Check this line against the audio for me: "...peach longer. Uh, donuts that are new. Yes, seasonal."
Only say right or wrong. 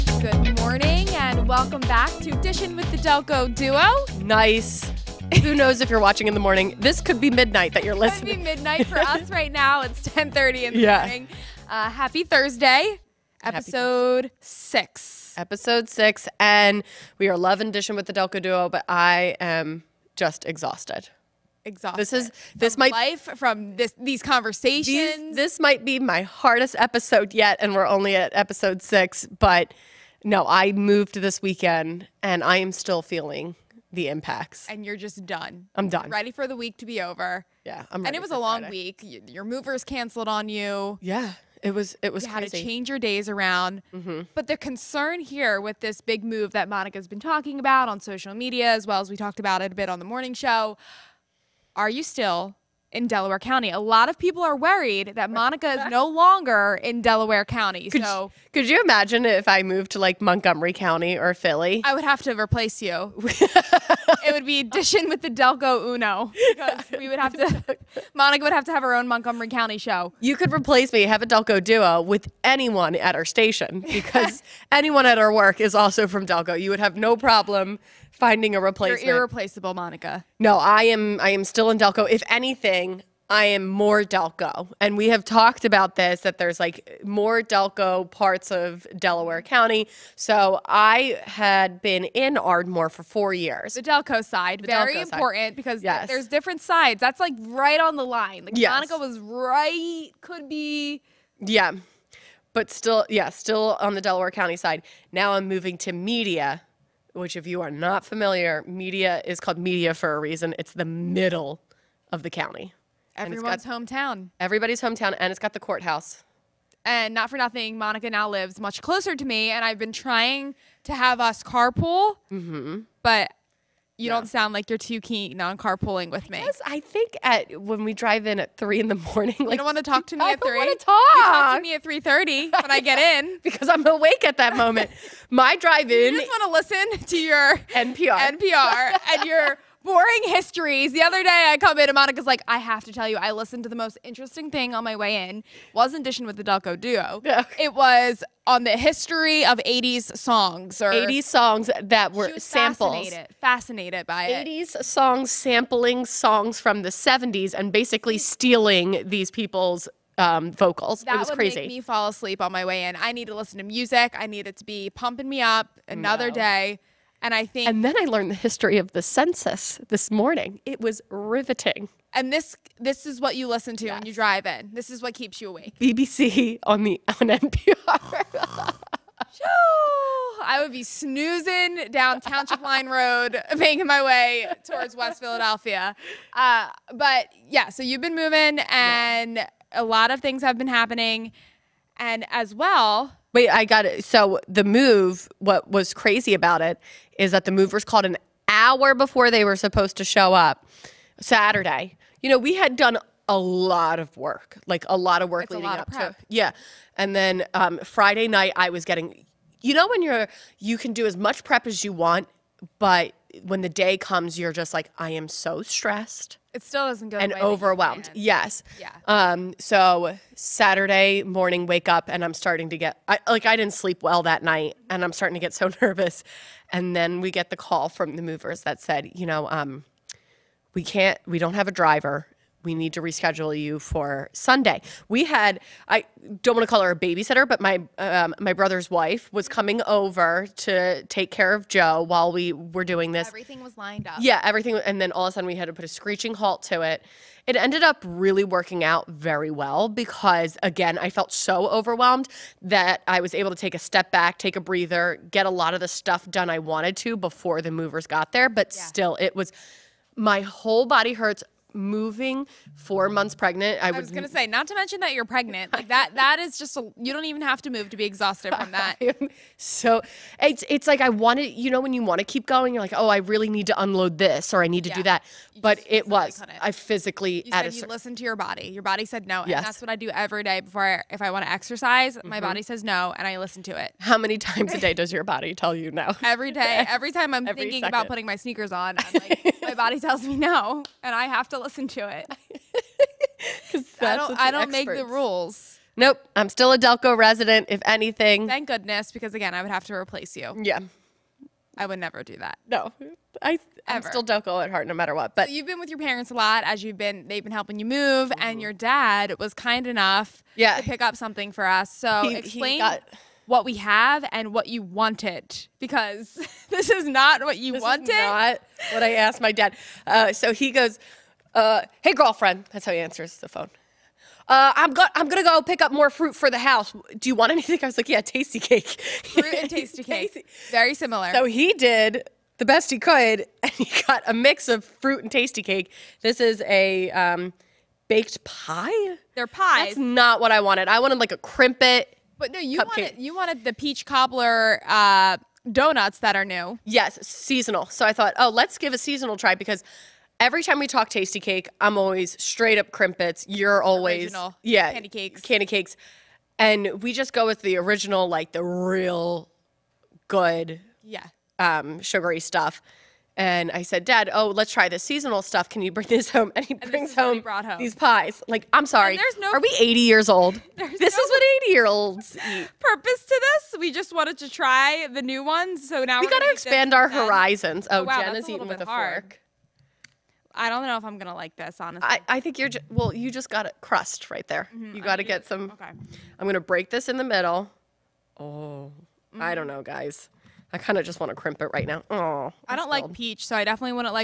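wrong.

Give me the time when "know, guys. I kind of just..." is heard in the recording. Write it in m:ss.
6:29.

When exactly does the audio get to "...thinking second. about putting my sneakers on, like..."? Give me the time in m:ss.
4:47.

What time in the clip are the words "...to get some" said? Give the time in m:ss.
6:25.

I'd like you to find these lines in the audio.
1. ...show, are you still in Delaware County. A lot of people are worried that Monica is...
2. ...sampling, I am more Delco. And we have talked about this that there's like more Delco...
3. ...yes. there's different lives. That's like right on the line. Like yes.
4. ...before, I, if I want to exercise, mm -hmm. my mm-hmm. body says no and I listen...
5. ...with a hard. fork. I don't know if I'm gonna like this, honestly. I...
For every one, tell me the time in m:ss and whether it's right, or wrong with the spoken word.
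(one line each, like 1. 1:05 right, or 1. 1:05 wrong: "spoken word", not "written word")
1. 0:50 right
2. 1:22 wrong: "anything", not "sampling"
3. 1:35 wrong: "sides", not "lives"
4. 4:40 right
5. 6:18 right.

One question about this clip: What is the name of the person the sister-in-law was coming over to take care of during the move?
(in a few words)
Joe.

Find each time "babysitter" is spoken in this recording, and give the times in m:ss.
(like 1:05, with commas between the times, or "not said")
3:56.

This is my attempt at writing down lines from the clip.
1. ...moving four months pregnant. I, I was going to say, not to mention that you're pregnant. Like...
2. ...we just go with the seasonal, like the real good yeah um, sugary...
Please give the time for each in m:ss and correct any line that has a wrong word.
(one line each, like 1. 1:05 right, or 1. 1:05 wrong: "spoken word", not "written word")
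1. 4:21 right
2. 5:57 wrong: "original", not "seasonal".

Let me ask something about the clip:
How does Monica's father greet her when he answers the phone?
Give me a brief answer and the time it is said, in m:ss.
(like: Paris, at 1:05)
Hey, girlfriend, at 5:22.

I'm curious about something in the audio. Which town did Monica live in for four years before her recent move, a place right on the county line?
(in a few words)
Ardmore.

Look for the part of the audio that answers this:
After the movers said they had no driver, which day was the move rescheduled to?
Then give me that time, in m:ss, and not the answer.
3:54.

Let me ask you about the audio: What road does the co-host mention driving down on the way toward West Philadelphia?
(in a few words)
Township Line Road.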